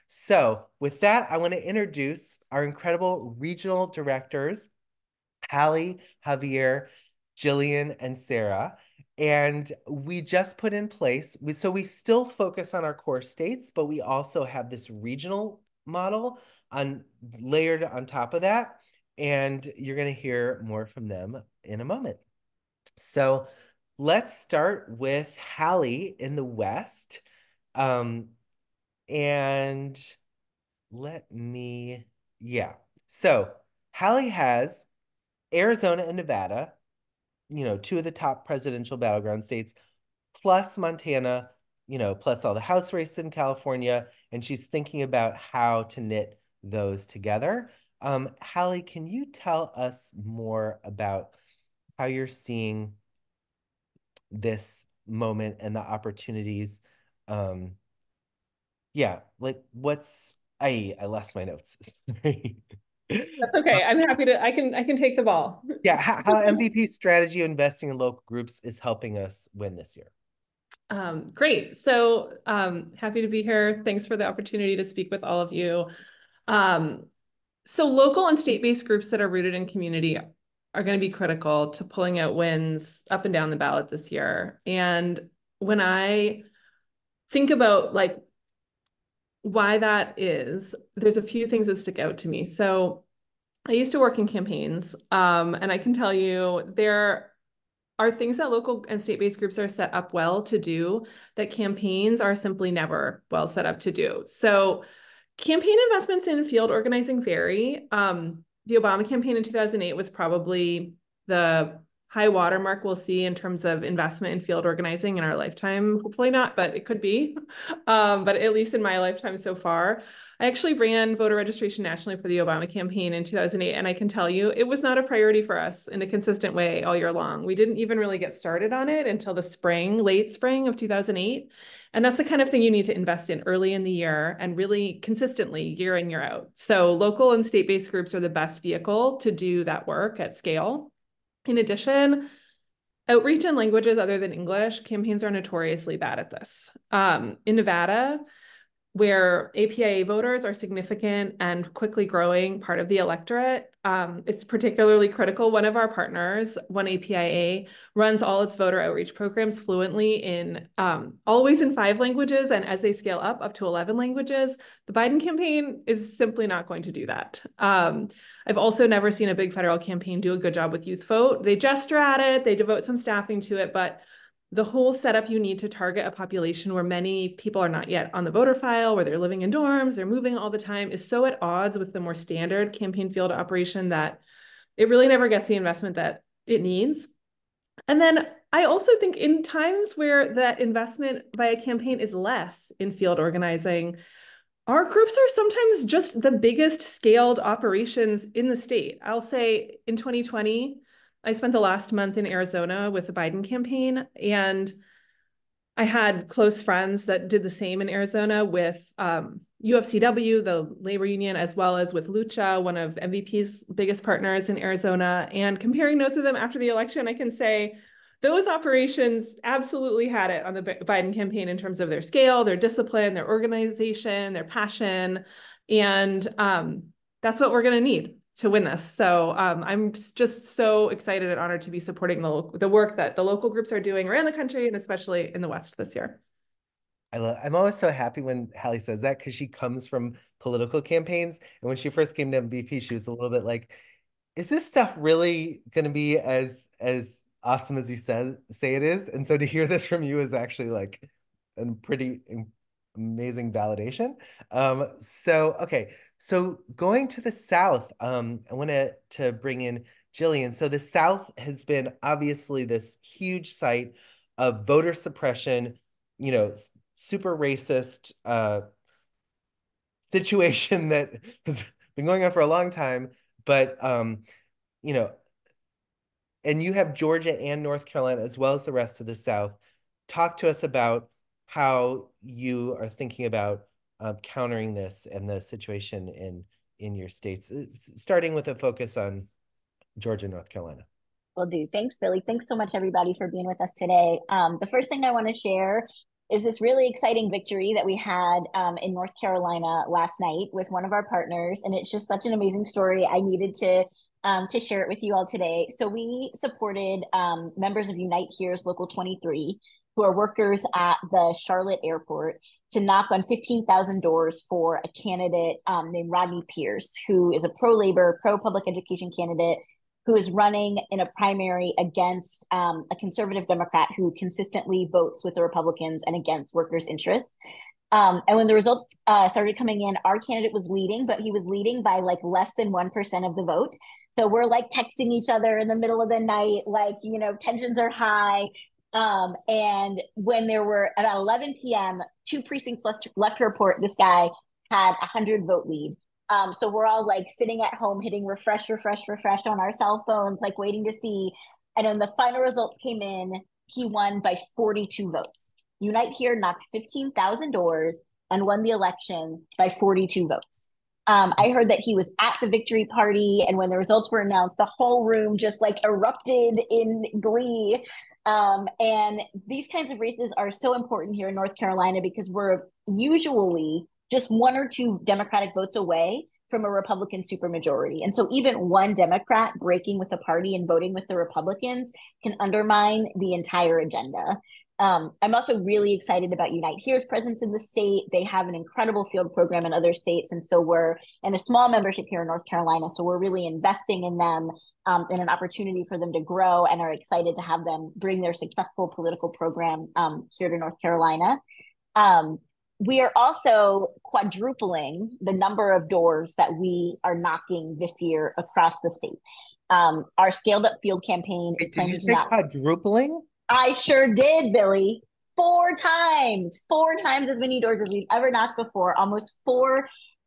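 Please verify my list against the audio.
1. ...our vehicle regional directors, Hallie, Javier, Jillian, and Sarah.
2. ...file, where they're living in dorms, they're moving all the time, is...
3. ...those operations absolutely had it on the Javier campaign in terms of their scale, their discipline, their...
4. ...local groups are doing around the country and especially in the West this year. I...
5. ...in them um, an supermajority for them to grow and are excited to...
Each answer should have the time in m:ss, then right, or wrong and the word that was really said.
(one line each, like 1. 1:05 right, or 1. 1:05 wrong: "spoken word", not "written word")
1. 0:02 wrong: "incredible", not "vehicle"
2. 2:58 right
3. 3:38 wrong: "Biden", not "Javier"
4. 3:53 right
5. 6:34 wrong: "opportunity", not "supermajority".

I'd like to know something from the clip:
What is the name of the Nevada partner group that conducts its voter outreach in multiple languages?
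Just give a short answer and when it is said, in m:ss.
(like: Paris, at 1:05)
One APIA, at 2:36.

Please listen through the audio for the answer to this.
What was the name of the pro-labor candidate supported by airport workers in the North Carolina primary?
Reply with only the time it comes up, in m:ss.
5:16.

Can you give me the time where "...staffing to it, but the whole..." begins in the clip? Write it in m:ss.
2:52.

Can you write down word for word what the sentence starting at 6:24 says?
Um, I'm also really excited about Unite Here's presence in the state.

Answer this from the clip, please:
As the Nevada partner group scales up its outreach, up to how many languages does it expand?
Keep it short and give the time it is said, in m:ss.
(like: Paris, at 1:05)
11, at 2:43.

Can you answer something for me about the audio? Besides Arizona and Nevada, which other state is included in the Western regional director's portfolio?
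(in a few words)
Montana.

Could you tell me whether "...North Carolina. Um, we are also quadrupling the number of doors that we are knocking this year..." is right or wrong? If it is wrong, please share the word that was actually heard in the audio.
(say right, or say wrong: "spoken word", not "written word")
right.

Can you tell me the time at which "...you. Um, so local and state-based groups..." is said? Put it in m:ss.
1:15.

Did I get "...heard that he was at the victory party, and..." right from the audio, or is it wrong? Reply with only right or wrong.
right.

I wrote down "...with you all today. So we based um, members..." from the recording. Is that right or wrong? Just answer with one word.
wrong.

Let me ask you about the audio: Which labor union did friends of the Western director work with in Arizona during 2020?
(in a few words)
UFCW.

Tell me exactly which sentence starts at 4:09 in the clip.
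And so to hear this from you is actually like a um, pretty amazing validation.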